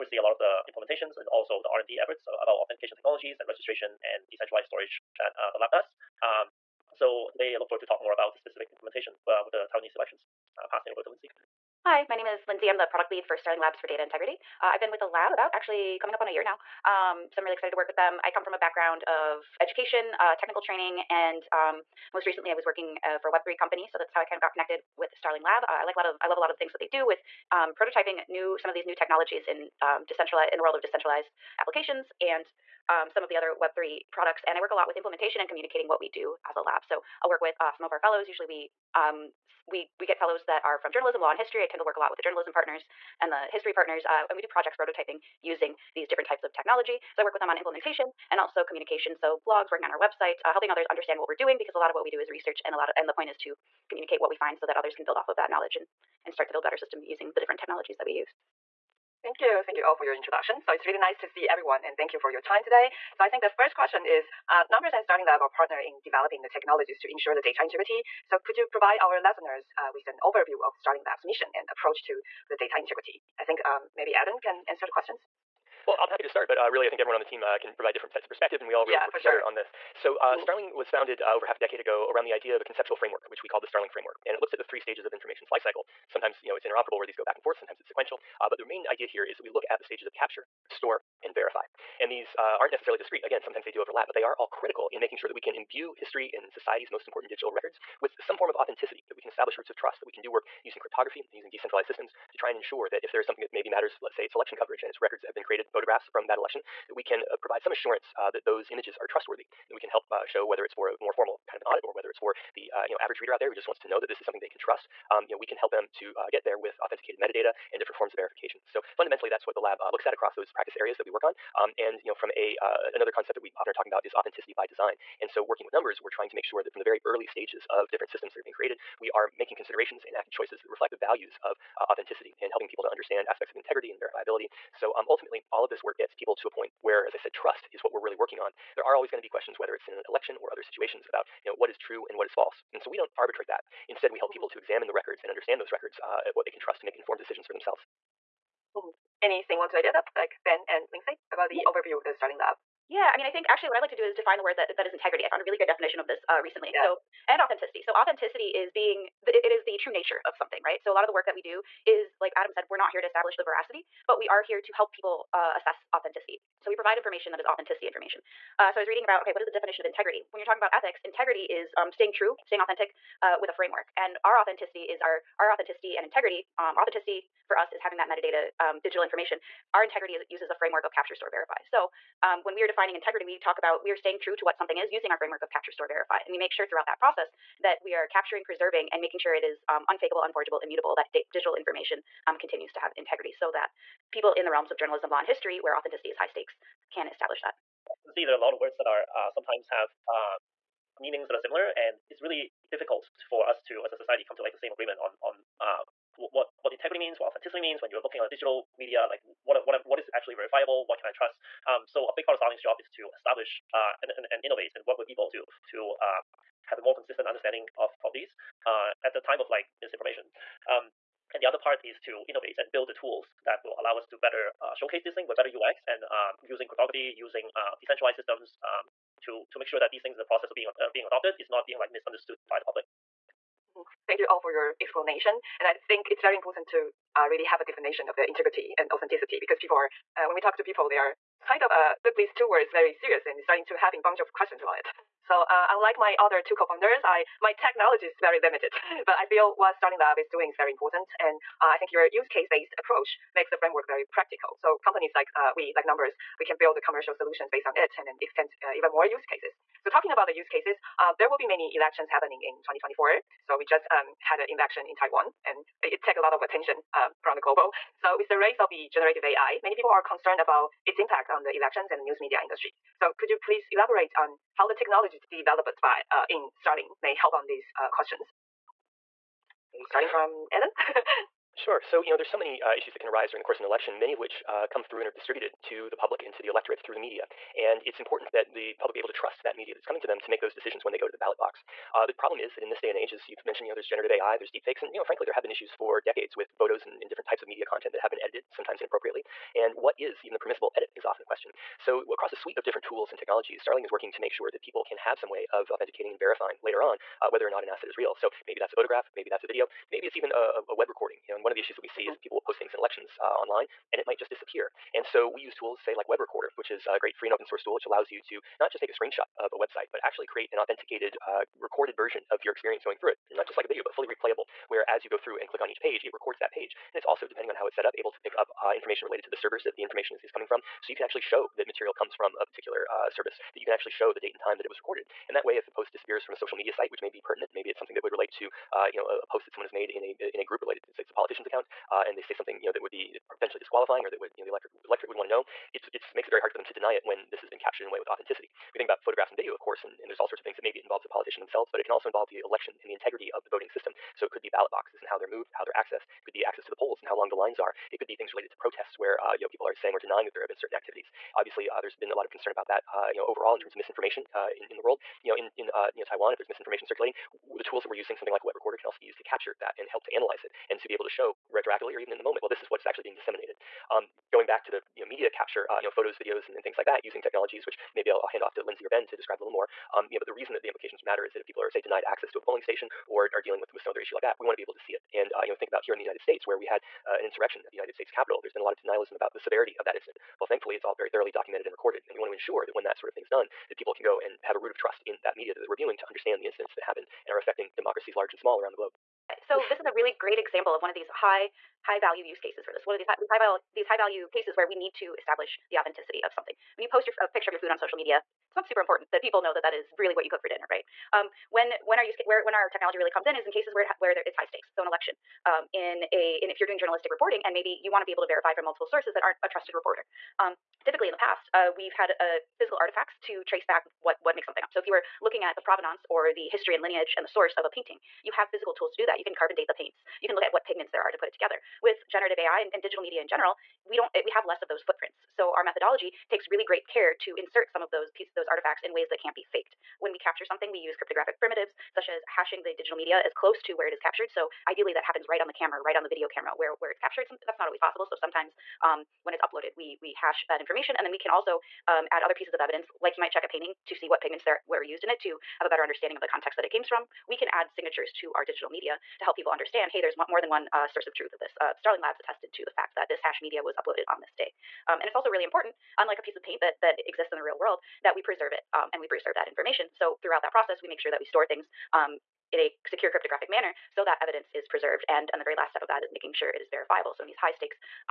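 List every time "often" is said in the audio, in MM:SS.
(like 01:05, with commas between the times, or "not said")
02:03, 05:01.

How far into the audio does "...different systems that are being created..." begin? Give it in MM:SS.
02:07.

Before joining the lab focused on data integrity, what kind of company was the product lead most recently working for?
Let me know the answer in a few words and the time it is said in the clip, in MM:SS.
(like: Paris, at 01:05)
Web3 company, at 00:23.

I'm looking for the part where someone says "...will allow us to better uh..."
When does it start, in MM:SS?
03:43.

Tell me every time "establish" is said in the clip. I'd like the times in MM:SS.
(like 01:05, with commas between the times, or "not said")
01:39, 02:43, 03:17, 03:33, 06:45.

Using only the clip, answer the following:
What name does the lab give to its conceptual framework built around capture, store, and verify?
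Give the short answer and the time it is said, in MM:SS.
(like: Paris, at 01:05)
Starling framework, at 01:23.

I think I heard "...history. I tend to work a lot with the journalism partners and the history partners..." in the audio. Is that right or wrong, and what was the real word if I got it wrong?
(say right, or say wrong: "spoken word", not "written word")
right.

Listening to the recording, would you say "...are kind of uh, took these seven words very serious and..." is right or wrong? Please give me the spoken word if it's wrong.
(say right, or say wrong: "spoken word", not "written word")
wrong: "two", not "seven".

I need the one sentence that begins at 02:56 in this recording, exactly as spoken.
Um, authenticity for us is having that metadata, um, digital information.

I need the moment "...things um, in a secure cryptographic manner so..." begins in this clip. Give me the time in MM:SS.
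07:51.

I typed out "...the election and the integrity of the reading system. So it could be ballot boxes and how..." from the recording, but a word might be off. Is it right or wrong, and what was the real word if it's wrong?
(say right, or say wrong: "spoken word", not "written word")
wrong: "voting", not "reading".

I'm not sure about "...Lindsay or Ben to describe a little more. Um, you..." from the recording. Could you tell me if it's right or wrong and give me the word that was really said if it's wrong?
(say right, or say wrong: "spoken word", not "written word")
right.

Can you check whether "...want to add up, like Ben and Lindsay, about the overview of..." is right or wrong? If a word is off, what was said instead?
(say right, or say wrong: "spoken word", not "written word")
right.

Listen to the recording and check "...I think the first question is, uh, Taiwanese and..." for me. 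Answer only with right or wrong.
wrong.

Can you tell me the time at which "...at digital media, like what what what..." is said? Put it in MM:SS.
03:28.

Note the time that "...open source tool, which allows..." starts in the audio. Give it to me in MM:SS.
05:17.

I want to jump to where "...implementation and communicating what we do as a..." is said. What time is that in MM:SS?
00:34.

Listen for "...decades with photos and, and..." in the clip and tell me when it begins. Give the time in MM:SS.
04:56.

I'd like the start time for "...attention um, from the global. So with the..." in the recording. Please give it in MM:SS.
04:26.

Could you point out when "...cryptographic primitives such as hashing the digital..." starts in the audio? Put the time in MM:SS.
07:20.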